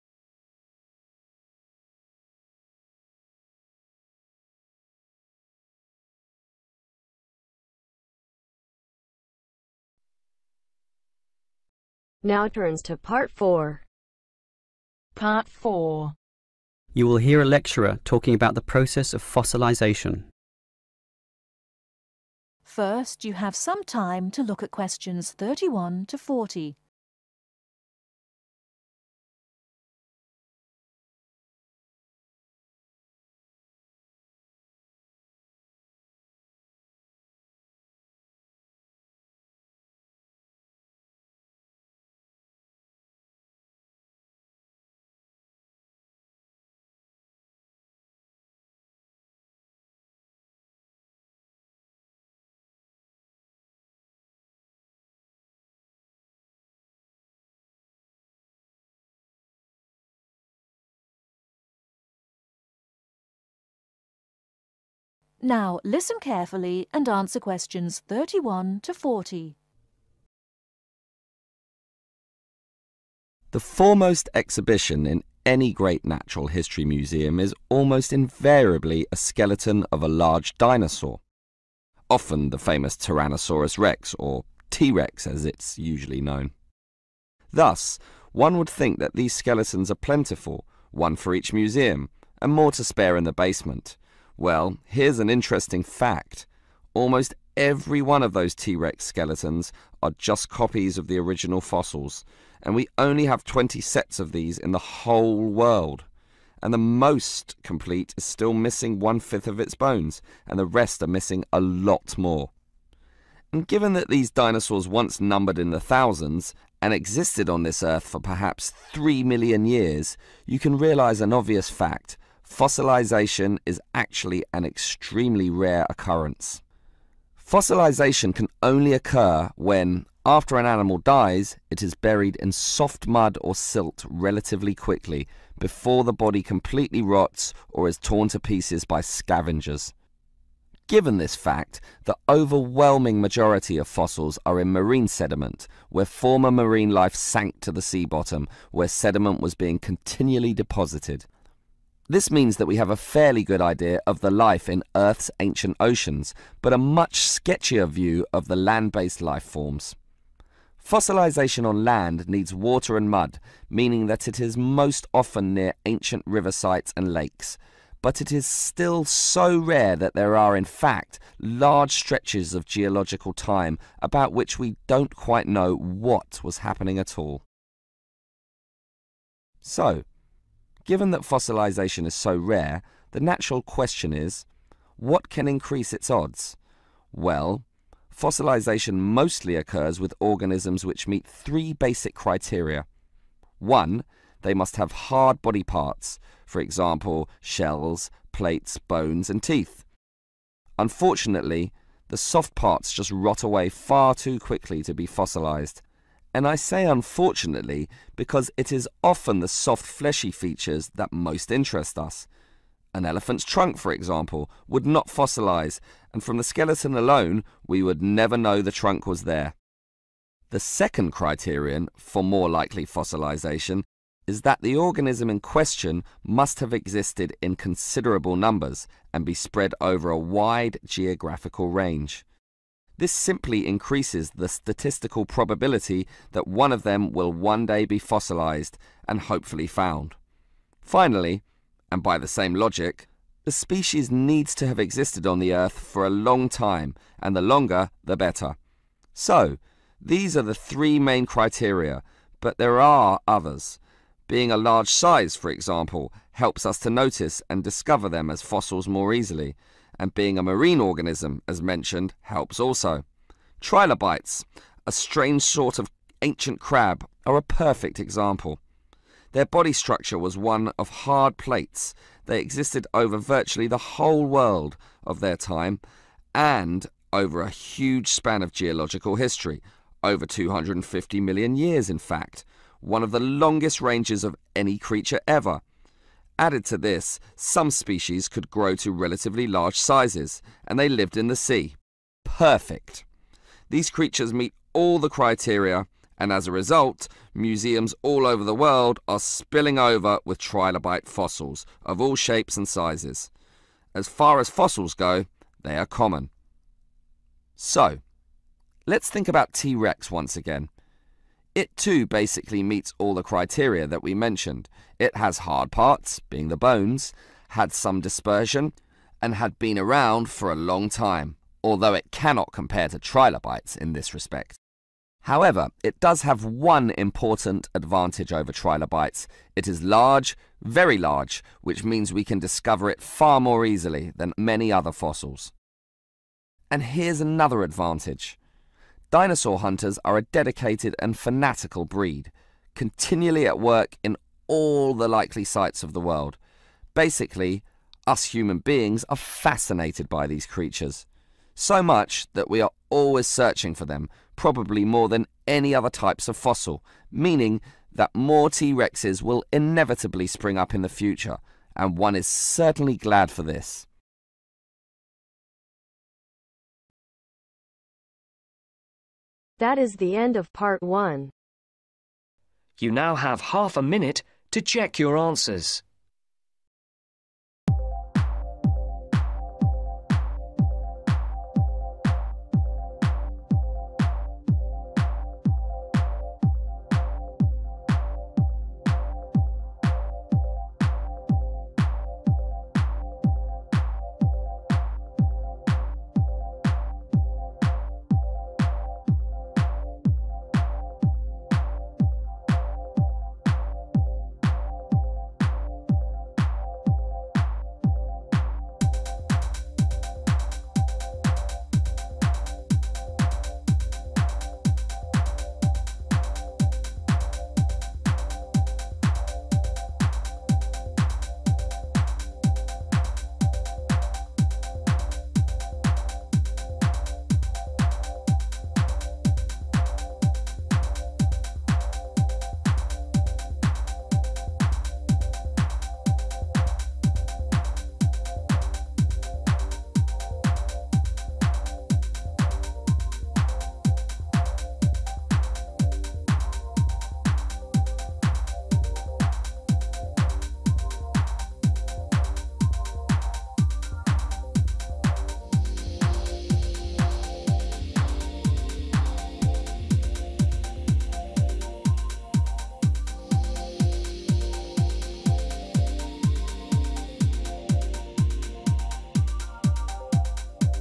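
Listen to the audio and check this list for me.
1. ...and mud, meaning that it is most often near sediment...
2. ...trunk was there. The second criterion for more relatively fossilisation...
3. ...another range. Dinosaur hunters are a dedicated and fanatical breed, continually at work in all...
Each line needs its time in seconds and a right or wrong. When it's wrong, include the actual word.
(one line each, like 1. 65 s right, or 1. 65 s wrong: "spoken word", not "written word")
1. 162 s wrong: "ancient", not "sediment"
2. 218 s wrong: "likely", not "relatively"
3. 337 s wrong: "advantage", not "range".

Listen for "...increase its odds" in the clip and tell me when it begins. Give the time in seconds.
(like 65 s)
185 s.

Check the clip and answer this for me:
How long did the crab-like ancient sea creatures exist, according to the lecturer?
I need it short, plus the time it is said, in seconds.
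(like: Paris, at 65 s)
over 250 million years, at 280 s.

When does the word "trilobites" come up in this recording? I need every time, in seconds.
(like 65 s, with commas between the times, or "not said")
263 s, 300 s, 322 s, 328 s.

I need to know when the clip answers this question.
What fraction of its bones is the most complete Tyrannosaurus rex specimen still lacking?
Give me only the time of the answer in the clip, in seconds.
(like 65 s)
108 s.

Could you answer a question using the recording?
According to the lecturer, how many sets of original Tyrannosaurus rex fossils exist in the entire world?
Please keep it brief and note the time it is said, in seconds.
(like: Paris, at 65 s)
20, at 103 s.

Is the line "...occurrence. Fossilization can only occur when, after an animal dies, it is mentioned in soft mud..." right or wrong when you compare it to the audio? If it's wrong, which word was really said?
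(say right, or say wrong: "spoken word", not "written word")
wrong: "buried", not "mentioned".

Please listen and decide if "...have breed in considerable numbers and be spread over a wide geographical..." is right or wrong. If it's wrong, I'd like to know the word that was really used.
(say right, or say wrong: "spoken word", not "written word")
wrong: "existed", not "breed".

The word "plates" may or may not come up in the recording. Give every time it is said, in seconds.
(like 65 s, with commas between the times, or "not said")
198 s, 271 s.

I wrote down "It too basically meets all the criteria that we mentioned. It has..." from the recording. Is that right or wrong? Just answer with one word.
right.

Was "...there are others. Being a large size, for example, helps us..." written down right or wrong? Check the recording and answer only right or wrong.
right.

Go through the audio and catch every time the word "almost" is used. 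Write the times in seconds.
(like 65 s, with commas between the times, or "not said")
77 s, 96 s.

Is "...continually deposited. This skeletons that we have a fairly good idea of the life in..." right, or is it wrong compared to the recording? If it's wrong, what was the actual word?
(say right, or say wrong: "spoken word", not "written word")
wrong: "means", not "skeletons".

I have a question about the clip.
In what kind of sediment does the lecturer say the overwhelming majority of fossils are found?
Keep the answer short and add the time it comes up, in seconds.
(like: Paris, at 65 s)
marine sediment, at 144 s.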